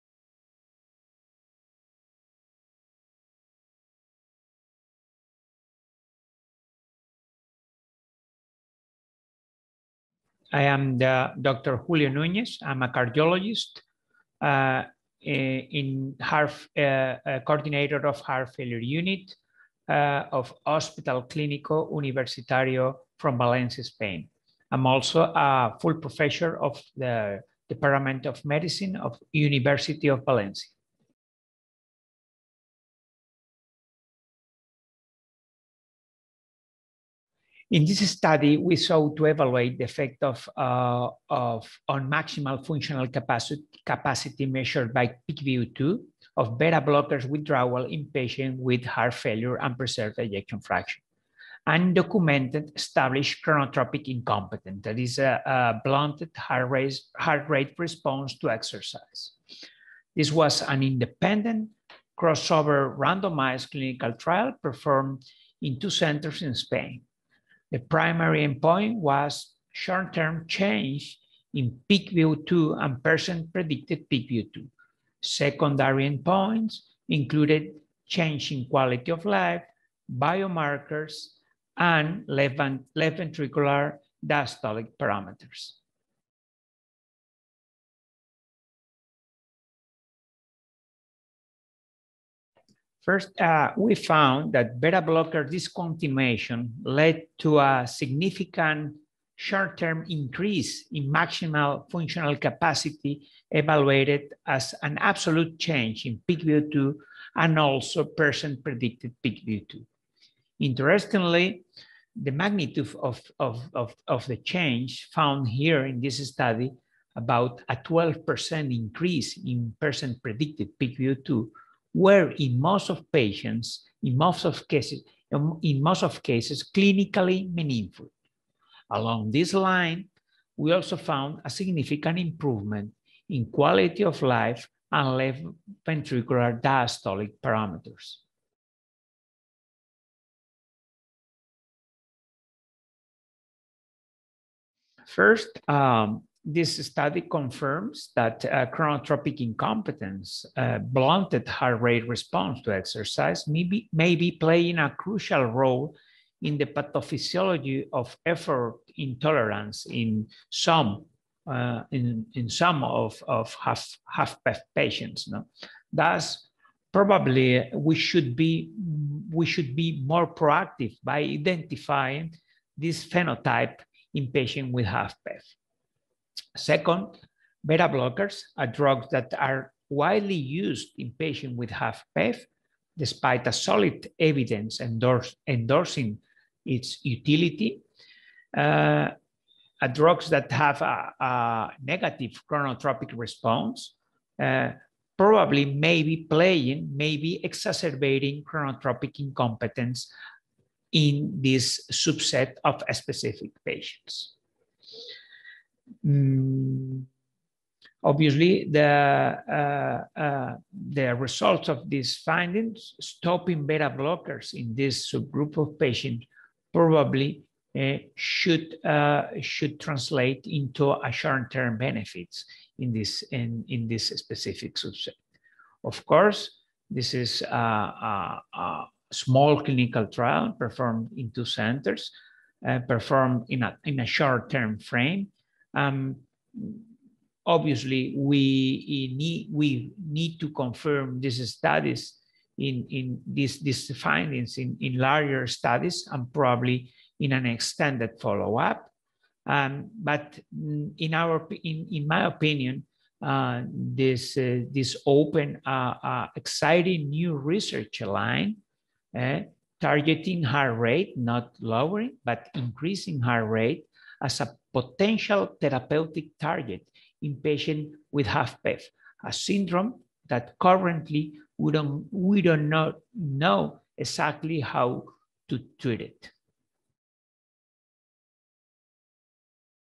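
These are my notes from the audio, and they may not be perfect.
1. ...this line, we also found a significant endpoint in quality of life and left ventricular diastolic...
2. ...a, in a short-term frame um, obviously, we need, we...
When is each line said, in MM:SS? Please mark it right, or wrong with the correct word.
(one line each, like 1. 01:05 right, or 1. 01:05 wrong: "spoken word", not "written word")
1. 02:09 wrong: "improvement", not "endpoint"
2. 03:53 right.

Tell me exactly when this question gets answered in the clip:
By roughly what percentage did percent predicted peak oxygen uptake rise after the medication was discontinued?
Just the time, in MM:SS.
01:57.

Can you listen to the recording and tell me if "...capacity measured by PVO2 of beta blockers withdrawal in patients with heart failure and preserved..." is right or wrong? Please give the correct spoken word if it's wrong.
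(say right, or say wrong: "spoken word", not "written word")
right.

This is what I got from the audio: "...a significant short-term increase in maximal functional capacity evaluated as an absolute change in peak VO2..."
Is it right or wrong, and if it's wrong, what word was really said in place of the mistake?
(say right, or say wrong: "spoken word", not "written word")
right.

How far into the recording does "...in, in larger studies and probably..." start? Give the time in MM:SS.
04:04.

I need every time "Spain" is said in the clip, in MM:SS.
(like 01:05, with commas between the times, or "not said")
00:23, 01:06.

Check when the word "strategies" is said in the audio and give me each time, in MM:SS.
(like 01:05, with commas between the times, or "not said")
not said.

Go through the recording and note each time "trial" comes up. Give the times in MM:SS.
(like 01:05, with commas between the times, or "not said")
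01:04, 03:50.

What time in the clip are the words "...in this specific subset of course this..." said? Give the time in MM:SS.
03:43.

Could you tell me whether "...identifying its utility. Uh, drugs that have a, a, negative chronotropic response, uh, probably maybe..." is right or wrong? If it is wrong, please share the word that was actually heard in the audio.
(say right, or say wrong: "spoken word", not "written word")
wrong: "endorsing", not "identifying".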